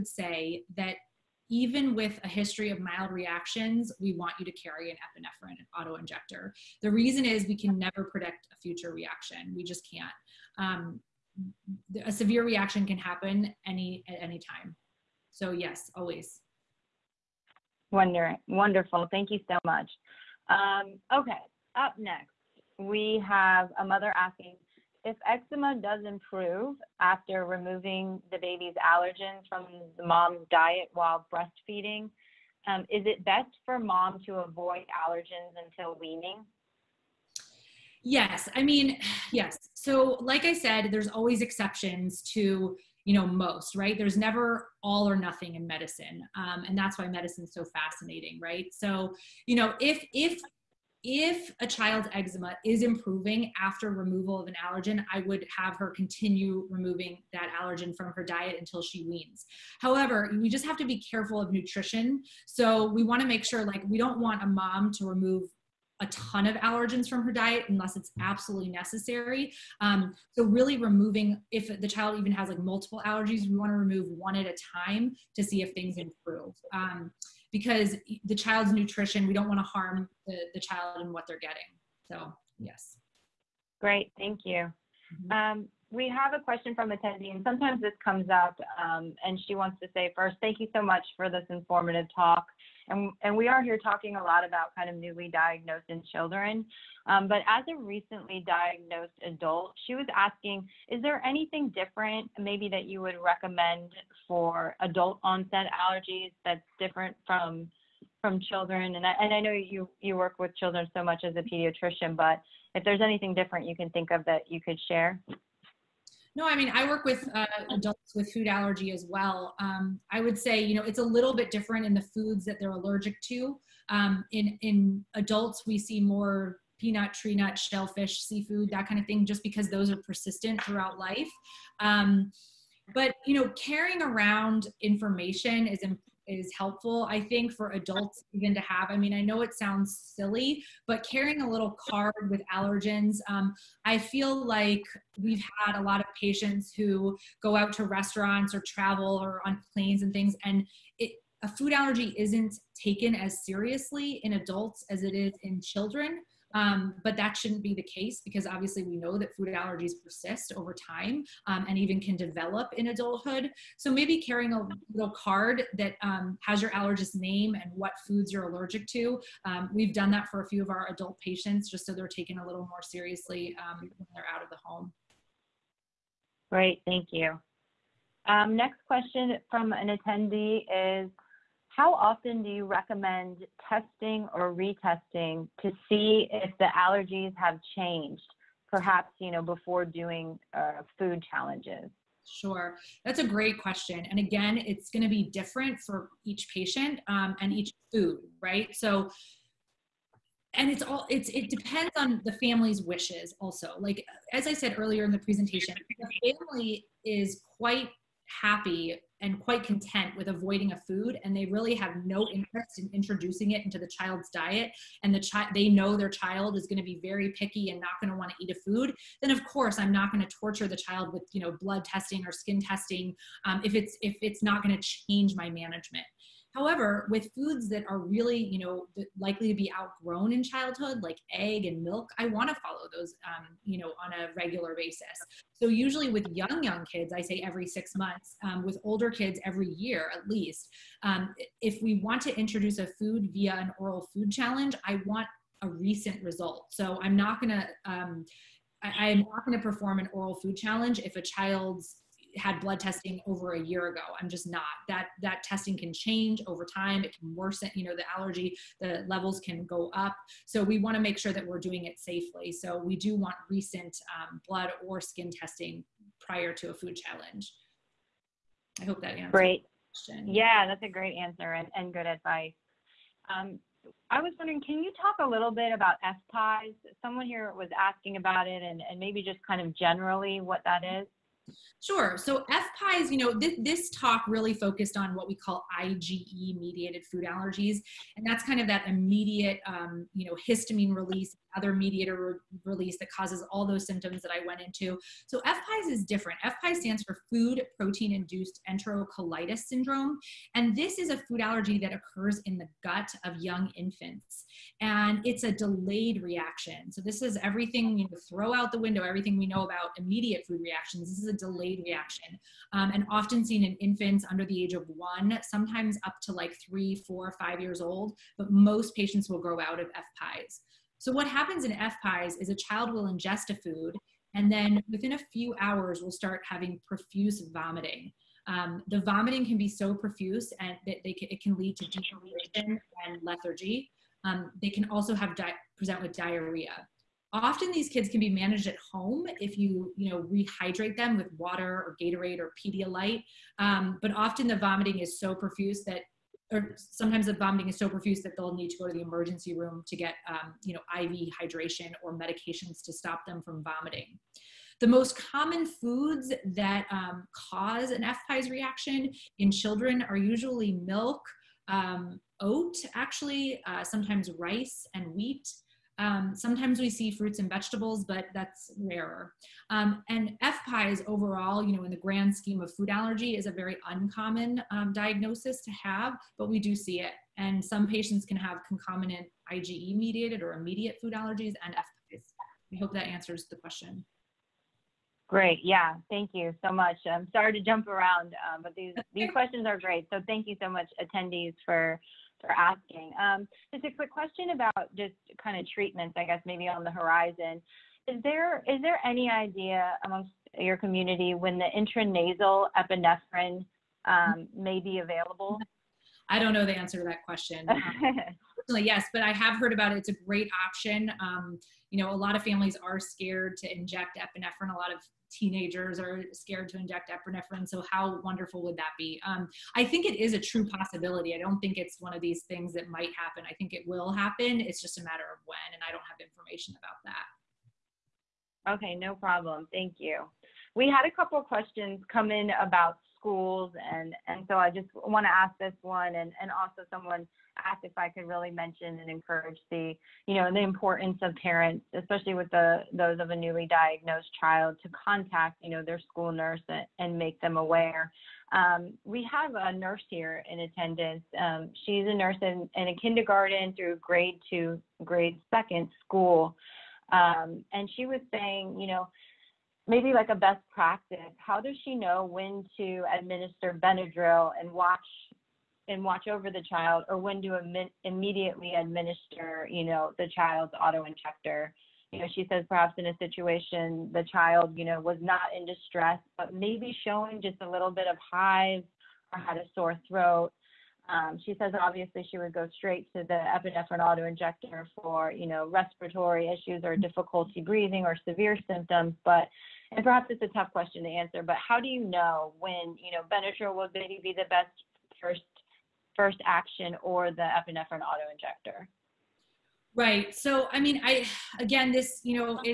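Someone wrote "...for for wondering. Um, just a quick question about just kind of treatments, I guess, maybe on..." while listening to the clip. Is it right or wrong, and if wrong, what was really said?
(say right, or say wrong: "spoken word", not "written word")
wrong: "asking", not "wondering".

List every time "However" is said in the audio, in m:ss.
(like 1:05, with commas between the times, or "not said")
0:59, 3:46.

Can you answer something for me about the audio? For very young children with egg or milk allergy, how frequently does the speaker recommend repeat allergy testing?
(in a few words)
Every 6 months.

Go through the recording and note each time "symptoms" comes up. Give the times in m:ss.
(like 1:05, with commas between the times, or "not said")
4:53, 8:08.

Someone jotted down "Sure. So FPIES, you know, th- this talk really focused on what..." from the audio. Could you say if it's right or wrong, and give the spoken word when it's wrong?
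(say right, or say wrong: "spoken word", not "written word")
right.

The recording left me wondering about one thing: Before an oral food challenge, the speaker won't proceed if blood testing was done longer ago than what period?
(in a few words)
Over a year ago.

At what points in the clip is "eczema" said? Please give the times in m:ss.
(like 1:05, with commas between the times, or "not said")
0:25, 0:52.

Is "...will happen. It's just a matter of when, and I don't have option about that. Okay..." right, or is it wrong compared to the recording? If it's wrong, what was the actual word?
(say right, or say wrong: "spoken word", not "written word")
wrong: "information", not "option".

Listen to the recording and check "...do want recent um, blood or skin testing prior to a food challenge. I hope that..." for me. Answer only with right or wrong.
right.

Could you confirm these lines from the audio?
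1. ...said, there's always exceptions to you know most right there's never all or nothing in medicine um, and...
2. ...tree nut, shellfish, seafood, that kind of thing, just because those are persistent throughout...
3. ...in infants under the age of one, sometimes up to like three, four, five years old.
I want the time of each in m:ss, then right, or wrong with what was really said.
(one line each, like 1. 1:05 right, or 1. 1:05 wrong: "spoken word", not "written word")
1. 0:40 right
2. 2:07 right
3. 5:13 right.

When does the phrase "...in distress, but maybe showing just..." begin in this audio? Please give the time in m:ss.
7:55.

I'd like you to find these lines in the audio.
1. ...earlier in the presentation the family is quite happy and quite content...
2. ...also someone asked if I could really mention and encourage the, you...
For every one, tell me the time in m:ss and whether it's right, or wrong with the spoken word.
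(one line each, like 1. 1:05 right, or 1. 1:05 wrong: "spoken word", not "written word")
1. 3:24 right
2. 7:16 right.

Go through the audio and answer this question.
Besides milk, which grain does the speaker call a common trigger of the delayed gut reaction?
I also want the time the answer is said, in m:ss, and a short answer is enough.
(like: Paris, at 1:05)
Oat, at 6:02.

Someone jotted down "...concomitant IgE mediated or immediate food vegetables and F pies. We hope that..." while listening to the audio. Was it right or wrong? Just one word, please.
wrong.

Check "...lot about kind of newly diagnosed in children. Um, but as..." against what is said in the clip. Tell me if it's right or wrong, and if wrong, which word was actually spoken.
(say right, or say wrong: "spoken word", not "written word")
right.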